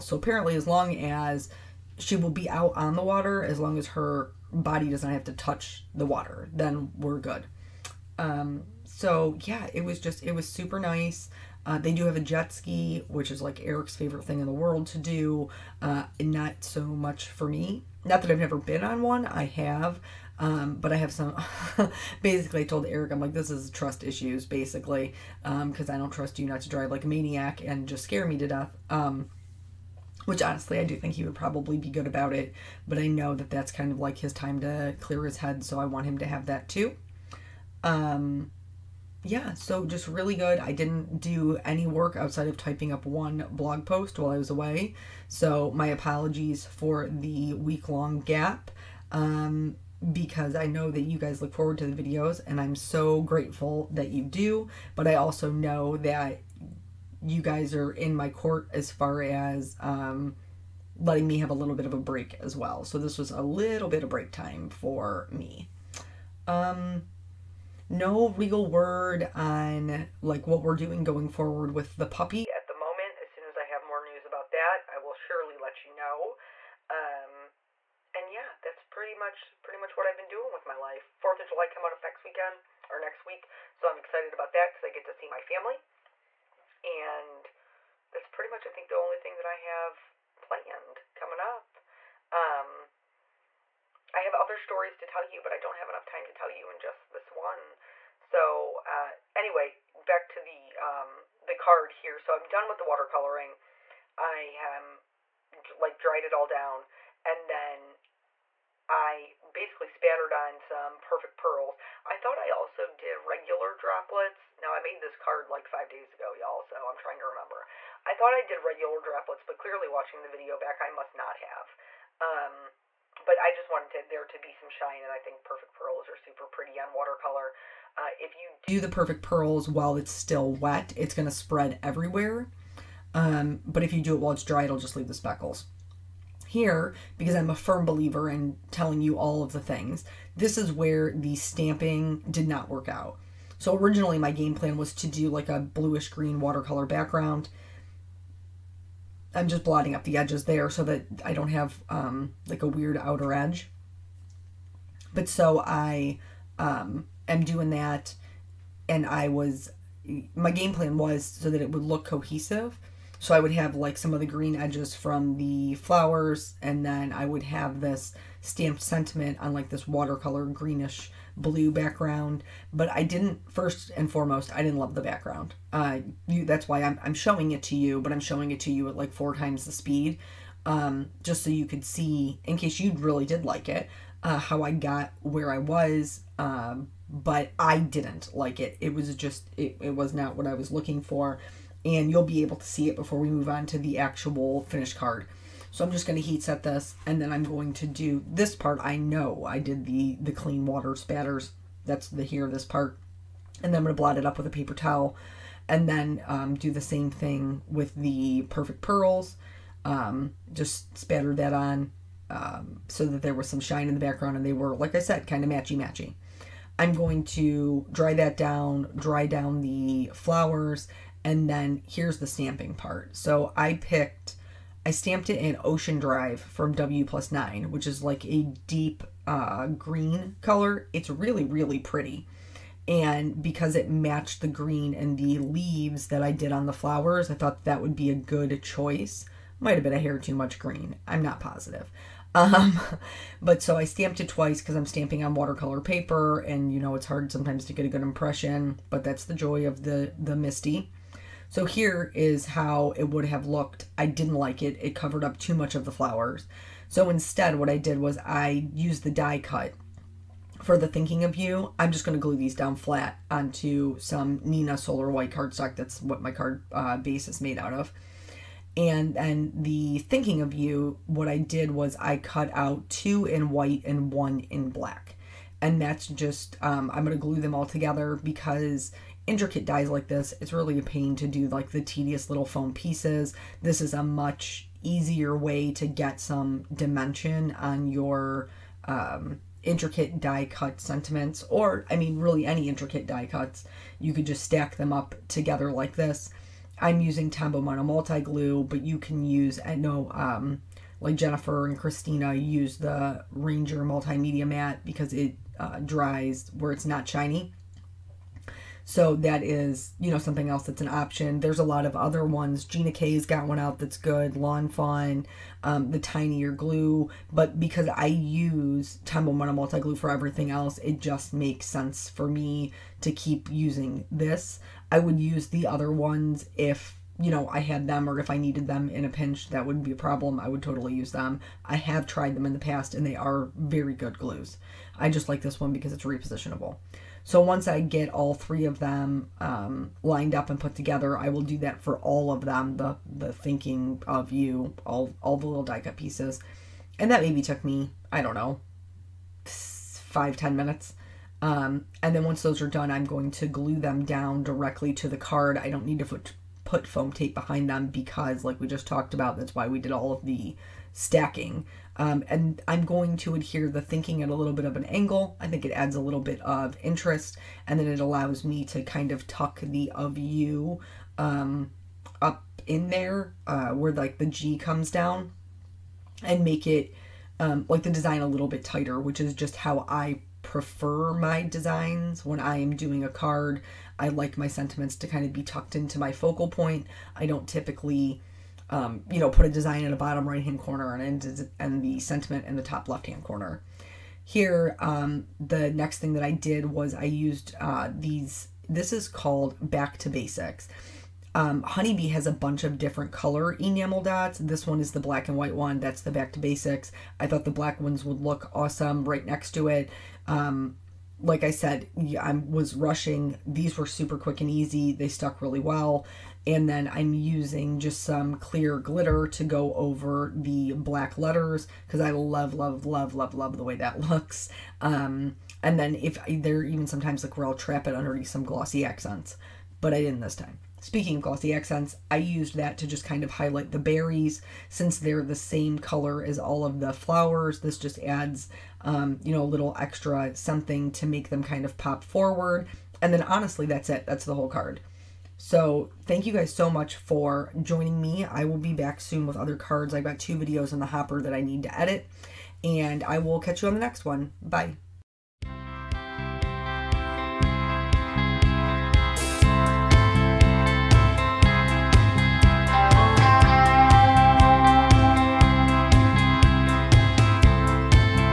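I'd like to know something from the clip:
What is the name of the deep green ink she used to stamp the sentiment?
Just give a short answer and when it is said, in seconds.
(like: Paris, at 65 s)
Ocean Drive, at 225 s.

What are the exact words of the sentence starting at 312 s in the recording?
Gina K's got one out that's good.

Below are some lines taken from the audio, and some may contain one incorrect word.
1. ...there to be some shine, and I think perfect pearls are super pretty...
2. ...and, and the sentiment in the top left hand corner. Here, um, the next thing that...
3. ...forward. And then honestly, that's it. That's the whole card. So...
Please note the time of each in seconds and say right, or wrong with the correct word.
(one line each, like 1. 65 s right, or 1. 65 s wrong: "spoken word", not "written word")
1. 124 s right
2. 390 s right
3. 442 s right.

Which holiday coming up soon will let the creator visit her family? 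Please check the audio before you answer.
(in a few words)
Fourth of July.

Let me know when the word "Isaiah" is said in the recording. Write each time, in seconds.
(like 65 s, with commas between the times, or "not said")
not said.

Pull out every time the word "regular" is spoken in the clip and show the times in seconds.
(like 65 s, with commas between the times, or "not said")
113 s, 118 s.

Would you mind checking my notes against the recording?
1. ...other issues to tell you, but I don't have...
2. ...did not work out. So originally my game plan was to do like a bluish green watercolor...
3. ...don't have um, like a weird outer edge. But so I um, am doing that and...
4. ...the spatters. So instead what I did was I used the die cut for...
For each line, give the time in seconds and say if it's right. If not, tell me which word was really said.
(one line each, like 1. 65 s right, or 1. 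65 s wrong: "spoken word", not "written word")
1. 94 s wrong: "stories", not "issues"
2. 142 s right
3. 151 s right
4. 255 s wrong: "flowers", not "spatters".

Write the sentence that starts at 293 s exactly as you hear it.
You could just stack them up together like this.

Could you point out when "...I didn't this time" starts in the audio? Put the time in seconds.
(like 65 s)
429 s.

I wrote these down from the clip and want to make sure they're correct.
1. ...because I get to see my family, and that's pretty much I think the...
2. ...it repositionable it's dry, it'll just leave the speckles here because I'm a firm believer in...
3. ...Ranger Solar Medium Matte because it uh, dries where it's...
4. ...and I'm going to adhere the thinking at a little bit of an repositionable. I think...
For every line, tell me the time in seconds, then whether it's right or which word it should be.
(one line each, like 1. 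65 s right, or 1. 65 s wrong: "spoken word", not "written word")
1. 84 s right
2. 134 s wrong: "while", not "repositionable"
3. 303 s wrong: "Multi", not "Solar"
4. 362 s wrong: "angle", not "repositionable".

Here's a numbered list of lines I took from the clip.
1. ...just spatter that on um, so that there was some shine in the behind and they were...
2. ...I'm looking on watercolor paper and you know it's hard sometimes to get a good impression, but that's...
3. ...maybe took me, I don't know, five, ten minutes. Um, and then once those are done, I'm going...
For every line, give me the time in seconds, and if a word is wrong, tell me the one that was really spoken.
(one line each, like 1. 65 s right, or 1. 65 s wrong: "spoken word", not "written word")
1. 210 s wrong: "background", not "behind"
2. 244 s wrong: "stamping", not "looking"
3. 347 s right.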